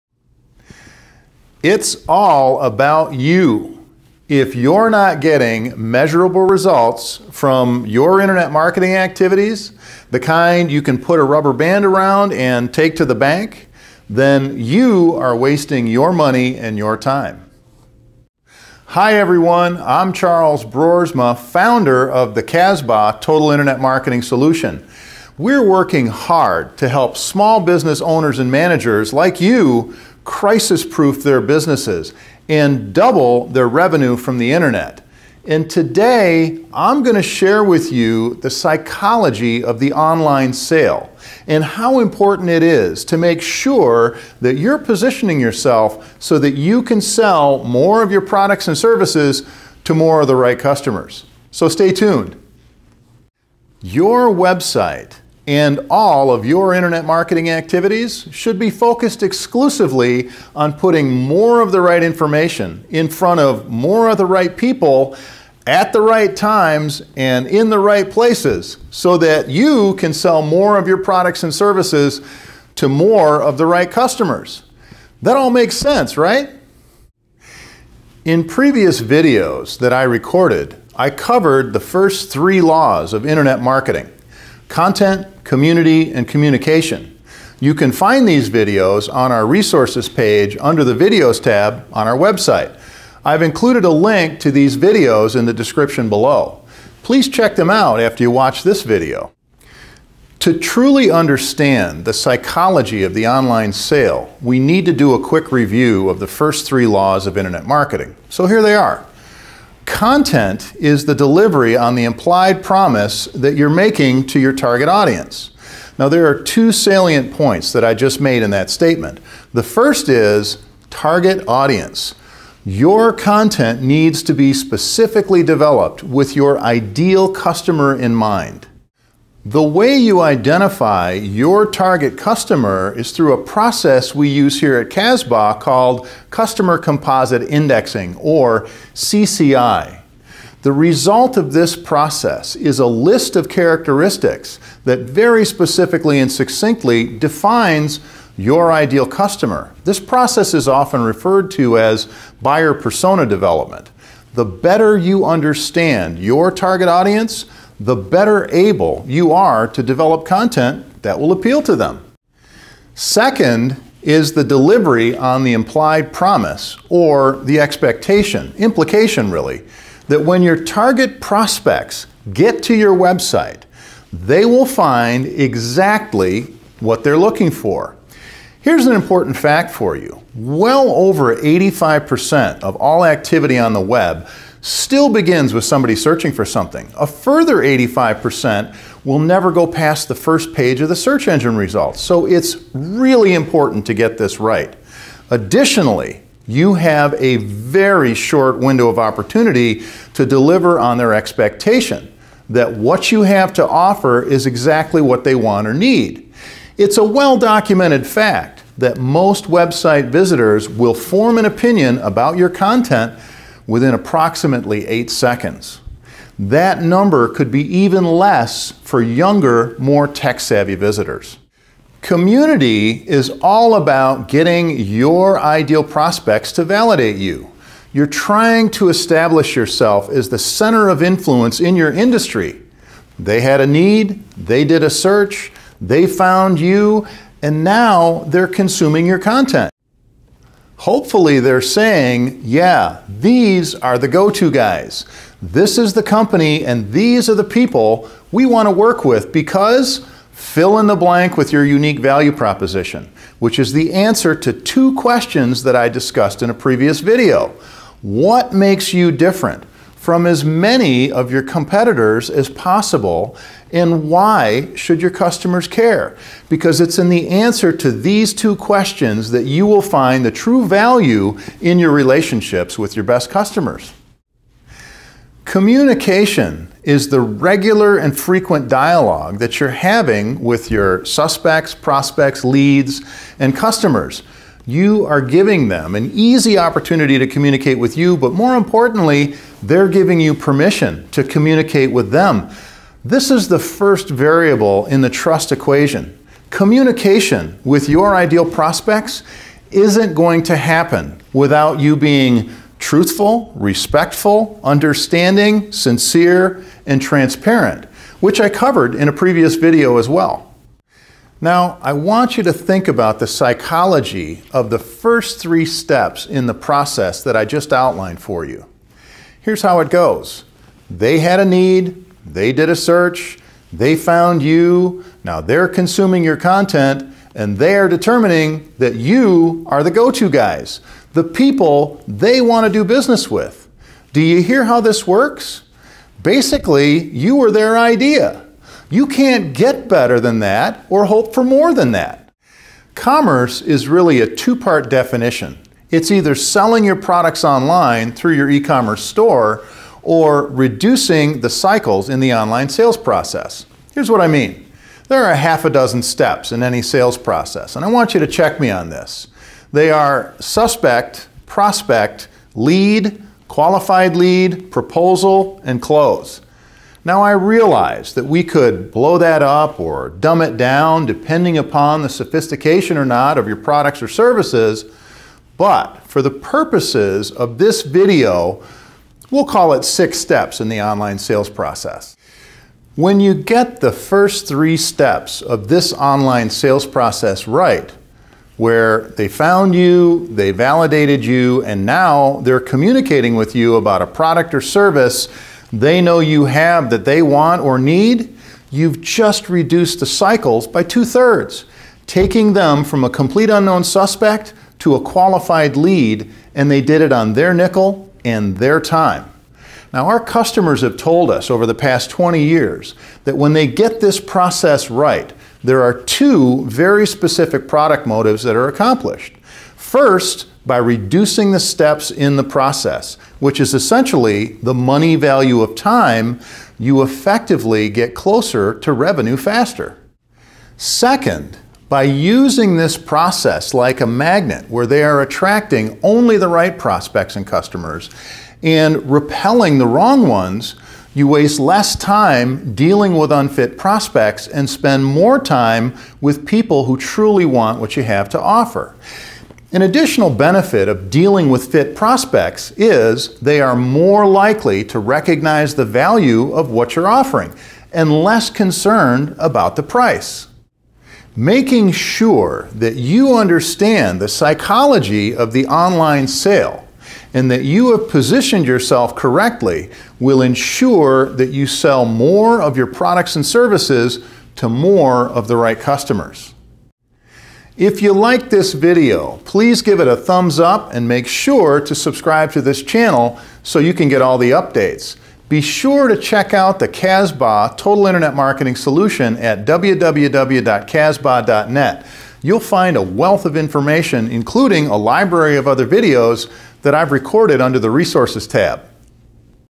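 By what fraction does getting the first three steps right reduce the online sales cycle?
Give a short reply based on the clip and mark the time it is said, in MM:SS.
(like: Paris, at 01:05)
two thirds, at 06:40.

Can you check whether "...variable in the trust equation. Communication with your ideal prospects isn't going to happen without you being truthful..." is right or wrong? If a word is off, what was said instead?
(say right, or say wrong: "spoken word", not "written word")
right.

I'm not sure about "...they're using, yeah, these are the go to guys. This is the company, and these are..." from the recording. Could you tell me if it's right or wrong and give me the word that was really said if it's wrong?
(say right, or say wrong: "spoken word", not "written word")
wrong: "saying", not "using".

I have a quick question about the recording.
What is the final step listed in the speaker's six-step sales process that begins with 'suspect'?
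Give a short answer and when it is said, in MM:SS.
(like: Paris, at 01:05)
close, at 06:05.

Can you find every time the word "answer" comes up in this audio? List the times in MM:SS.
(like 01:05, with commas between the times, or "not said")
04:13, 04:27.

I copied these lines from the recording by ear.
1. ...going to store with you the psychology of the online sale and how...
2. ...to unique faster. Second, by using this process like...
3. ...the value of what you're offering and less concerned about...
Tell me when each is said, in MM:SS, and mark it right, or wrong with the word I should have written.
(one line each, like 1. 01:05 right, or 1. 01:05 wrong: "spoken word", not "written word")
1. 00:37 wrong: "share", not "store"
2. 07:08 wrong: "revenue", not "unique"
3. 07:35 right.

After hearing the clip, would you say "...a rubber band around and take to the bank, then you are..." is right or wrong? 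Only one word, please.
right.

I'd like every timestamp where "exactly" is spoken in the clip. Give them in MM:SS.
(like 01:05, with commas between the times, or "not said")
02:55, 03:24.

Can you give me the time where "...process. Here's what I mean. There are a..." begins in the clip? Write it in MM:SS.
05:52.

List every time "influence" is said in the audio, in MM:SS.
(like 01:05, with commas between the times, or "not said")
03:51.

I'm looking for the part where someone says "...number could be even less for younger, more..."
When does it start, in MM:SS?
03:36.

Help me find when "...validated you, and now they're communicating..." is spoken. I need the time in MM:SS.
06:30.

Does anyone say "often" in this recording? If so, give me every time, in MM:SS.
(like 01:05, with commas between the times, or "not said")
02:30.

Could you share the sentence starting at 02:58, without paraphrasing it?
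Here's an important fact for you.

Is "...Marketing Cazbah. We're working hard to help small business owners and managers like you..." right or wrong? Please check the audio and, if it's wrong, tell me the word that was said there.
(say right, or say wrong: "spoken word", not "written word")
wrong: "Solution", not "Cazbah".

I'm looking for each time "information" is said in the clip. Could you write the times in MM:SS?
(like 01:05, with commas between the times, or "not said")
01:02, 08:13.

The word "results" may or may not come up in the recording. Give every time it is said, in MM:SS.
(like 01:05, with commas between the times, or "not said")
00:06, 02:20, 03:11.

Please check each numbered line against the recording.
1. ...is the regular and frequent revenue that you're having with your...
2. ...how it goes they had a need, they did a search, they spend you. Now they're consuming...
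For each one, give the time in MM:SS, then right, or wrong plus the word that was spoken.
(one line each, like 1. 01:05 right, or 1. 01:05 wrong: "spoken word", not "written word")
1. 04:36 wrong: "dialogue", not "revenue"
2. 05:19 wrong: "found", not "spend".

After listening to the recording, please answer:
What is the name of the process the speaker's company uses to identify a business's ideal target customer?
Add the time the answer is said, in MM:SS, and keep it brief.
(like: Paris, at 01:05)
Customer Composite Indexing, at 02:16.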